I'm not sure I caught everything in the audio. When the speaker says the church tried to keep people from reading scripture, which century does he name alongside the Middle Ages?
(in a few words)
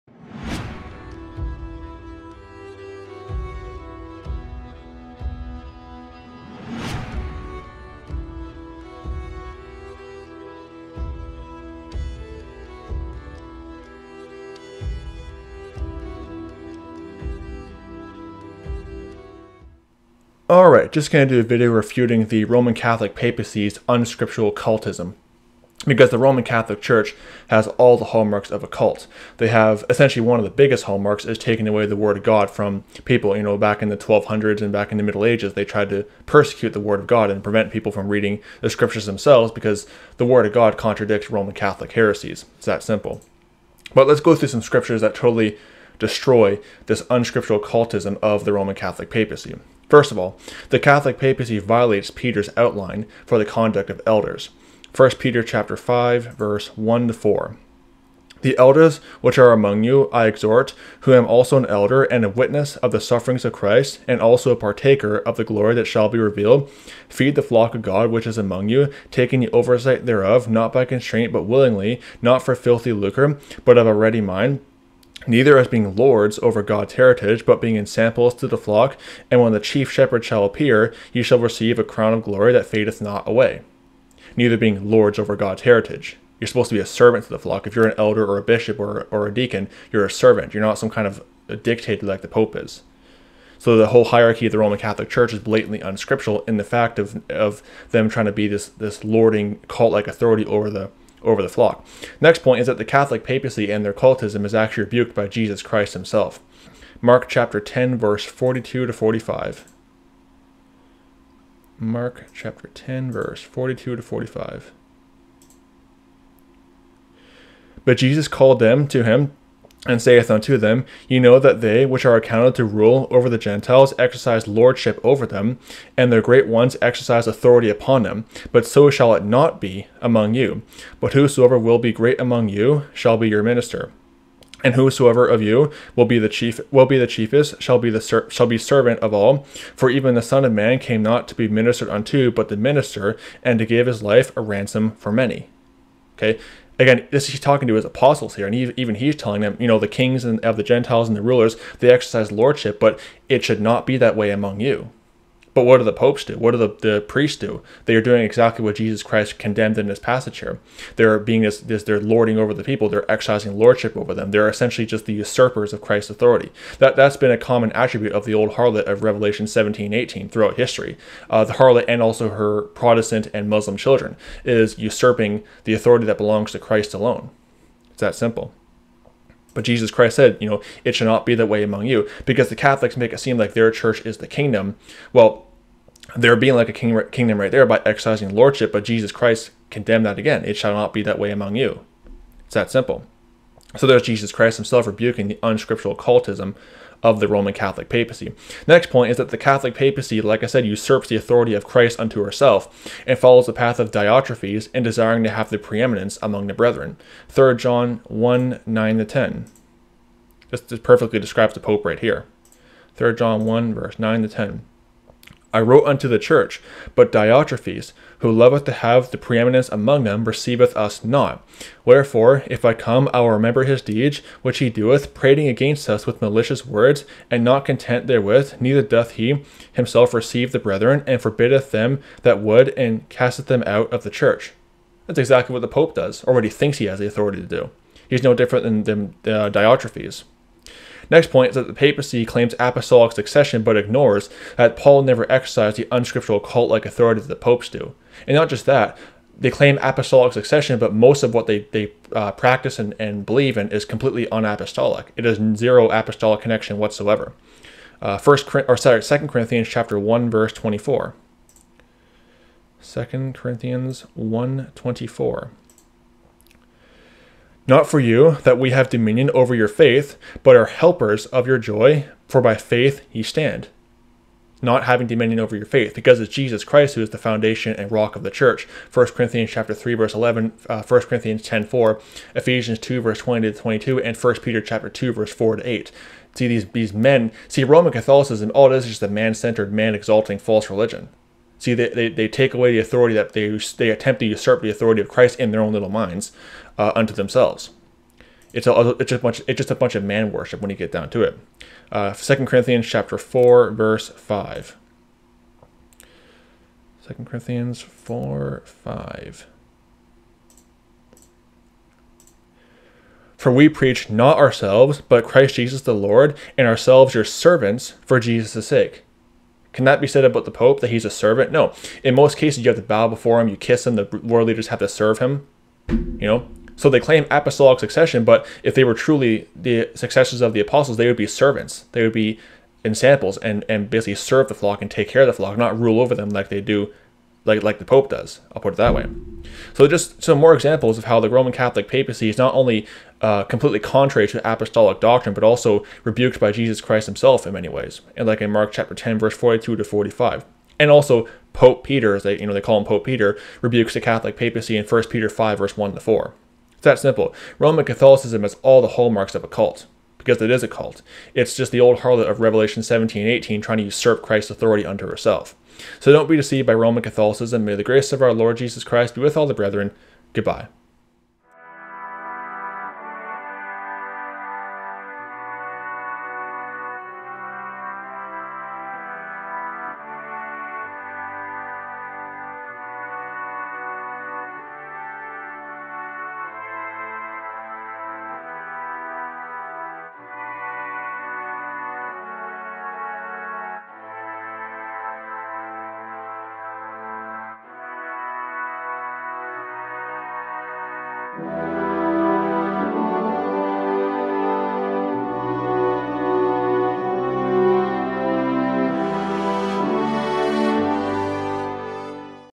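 1200s.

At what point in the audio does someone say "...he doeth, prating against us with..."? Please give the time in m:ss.
3:44.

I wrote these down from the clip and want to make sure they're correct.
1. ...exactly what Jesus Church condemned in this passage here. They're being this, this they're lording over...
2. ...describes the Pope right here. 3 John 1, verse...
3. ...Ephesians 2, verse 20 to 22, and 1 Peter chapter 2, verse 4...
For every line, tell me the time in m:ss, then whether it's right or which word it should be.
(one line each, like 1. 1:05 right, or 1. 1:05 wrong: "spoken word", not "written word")
1. 2:38 wrong: "Christ", not "Church"
2. 3:31 right
3. 4:42 right.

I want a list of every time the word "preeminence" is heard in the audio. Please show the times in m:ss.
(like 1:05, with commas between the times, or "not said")
3:25, 3:39.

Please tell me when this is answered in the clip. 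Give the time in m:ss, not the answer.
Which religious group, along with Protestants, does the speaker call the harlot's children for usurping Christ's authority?
2:53.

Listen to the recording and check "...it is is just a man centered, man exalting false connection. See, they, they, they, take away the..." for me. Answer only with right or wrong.
wrong.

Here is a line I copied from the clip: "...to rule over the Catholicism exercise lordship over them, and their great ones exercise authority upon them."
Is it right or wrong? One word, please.
wrong.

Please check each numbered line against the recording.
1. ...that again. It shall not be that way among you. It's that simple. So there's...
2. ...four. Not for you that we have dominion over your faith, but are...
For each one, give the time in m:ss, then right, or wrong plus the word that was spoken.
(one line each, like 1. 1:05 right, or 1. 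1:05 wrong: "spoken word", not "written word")
1. 3:10 right
2. 4:25 right.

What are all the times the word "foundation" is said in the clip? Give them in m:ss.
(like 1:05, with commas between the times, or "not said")
4:37.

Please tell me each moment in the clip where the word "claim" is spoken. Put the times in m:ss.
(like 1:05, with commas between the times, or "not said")
4:02, 4:09, 5:26.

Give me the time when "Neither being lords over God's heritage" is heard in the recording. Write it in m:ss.
1:24.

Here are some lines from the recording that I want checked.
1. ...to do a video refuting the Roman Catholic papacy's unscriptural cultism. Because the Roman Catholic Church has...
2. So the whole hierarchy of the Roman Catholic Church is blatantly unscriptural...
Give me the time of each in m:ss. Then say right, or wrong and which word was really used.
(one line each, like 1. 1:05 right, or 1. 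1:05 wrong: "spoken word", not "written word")
1. 0:21 right
2. 1:33 right.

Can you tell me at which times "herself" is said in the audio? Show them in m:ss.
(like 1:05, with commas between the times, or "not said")
3:22, 6:05.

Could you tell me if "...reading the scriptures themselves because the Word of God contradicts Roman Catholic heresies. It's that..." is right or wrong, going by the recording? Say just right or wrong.
right.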